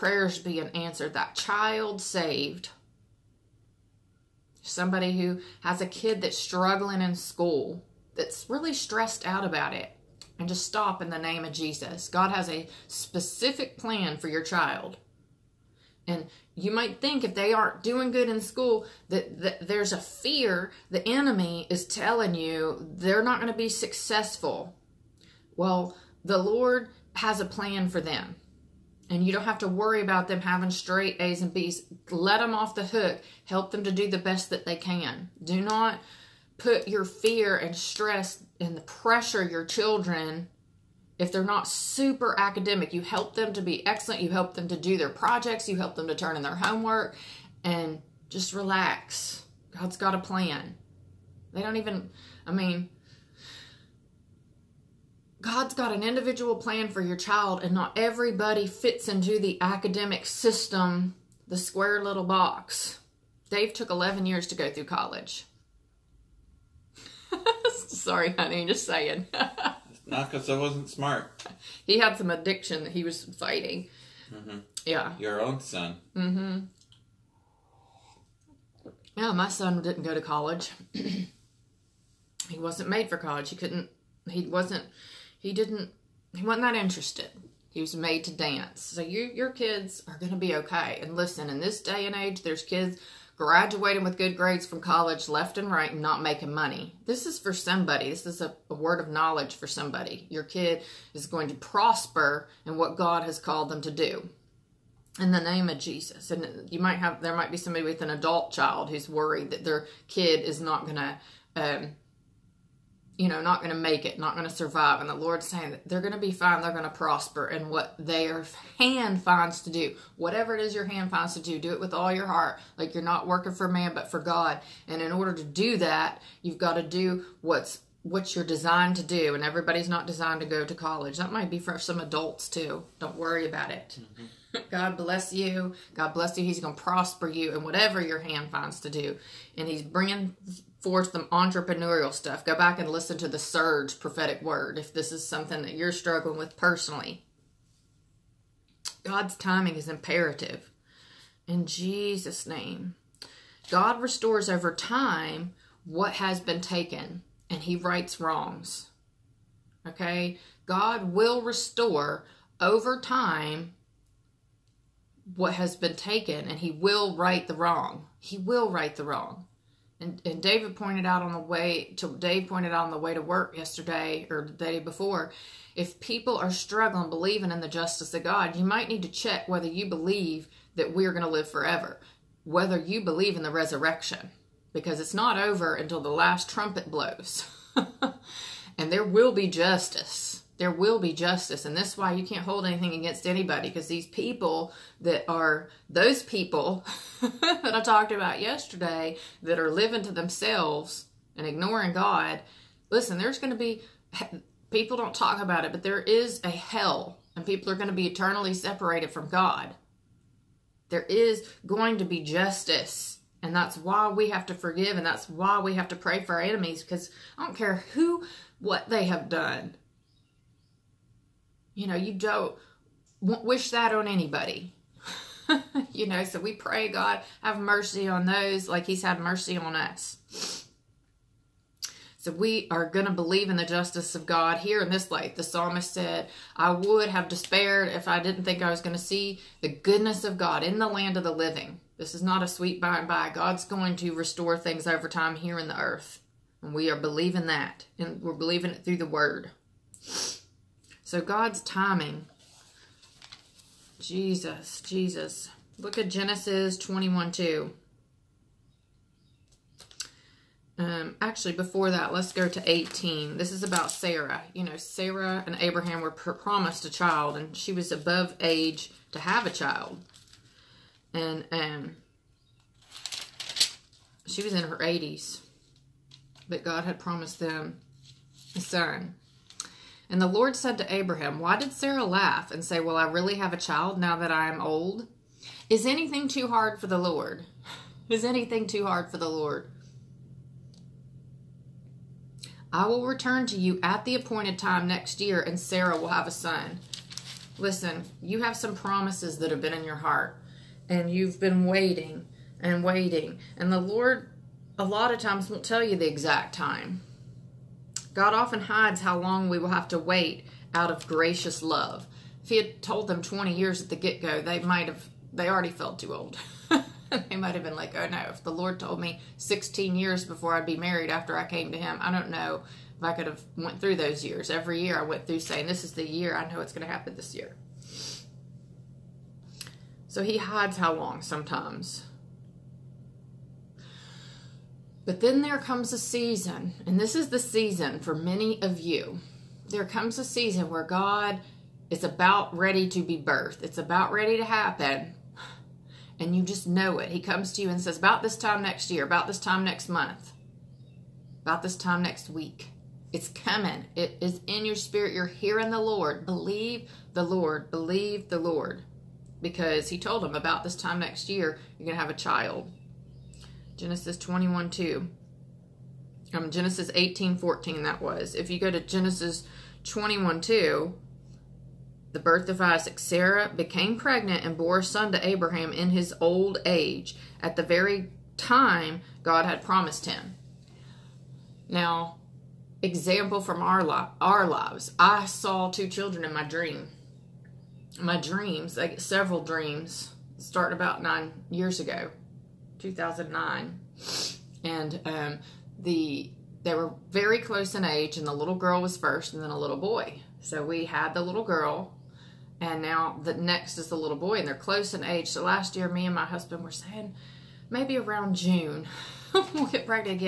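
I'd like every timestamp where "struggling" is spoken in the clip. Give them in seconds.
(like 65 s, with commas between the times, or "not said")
6 s, 145 s, 176 s.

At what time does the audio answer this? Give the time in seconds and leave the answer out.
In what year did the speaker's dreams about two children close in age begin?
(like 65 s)
392 s.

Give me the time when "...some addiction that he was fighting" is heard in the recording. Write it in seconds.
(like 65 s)
72 s.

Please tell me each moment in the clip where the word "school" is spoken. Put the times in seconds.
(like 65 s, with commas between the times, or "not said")
7 s, 18 s.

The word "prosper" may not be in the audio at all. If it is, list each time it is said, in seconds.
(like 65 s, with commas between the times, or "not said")
101 s, 116 s, 136 s.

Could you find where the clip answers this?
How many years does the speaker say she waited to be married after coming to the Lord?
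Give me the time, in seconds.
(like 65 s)
319 s.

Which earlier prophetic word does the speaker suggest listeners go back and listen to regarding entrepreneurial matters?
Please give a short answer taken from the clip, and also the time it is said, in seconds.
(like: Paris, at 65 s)
Surge, at 143 s.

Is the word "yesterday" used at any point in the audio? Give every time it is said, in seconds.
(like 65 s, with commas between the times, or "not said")
173 s, 198 s.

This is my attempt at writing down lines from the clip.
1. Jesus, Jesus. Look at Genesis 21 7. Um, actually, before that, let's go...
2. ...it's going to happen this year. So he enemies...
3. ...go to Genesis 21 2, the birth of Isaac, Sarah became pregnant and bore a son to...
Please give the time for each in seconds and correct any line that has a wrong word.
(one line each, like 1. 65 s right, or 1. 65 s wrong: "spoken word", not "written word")
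1. 253 s wrong: "2", not "7"
2. 326 s wrong: "hides", not "enemies"
3. 368 s right.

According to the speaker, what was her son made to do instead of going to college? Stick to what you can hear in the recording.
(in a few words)
dance.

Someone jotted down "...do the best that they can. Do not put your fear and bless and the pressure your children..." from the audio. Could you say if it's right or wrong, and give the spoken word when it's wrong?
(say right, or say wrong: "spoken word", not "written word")
wrong: "stress", not "bless".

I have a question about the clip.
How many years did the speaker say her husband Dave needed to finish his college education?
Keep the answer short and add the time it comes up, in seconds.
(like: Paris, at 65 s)
11, at 63 s.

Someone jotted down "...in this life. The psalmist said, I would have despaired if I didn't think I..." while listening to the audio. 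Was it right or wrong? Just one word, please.
right.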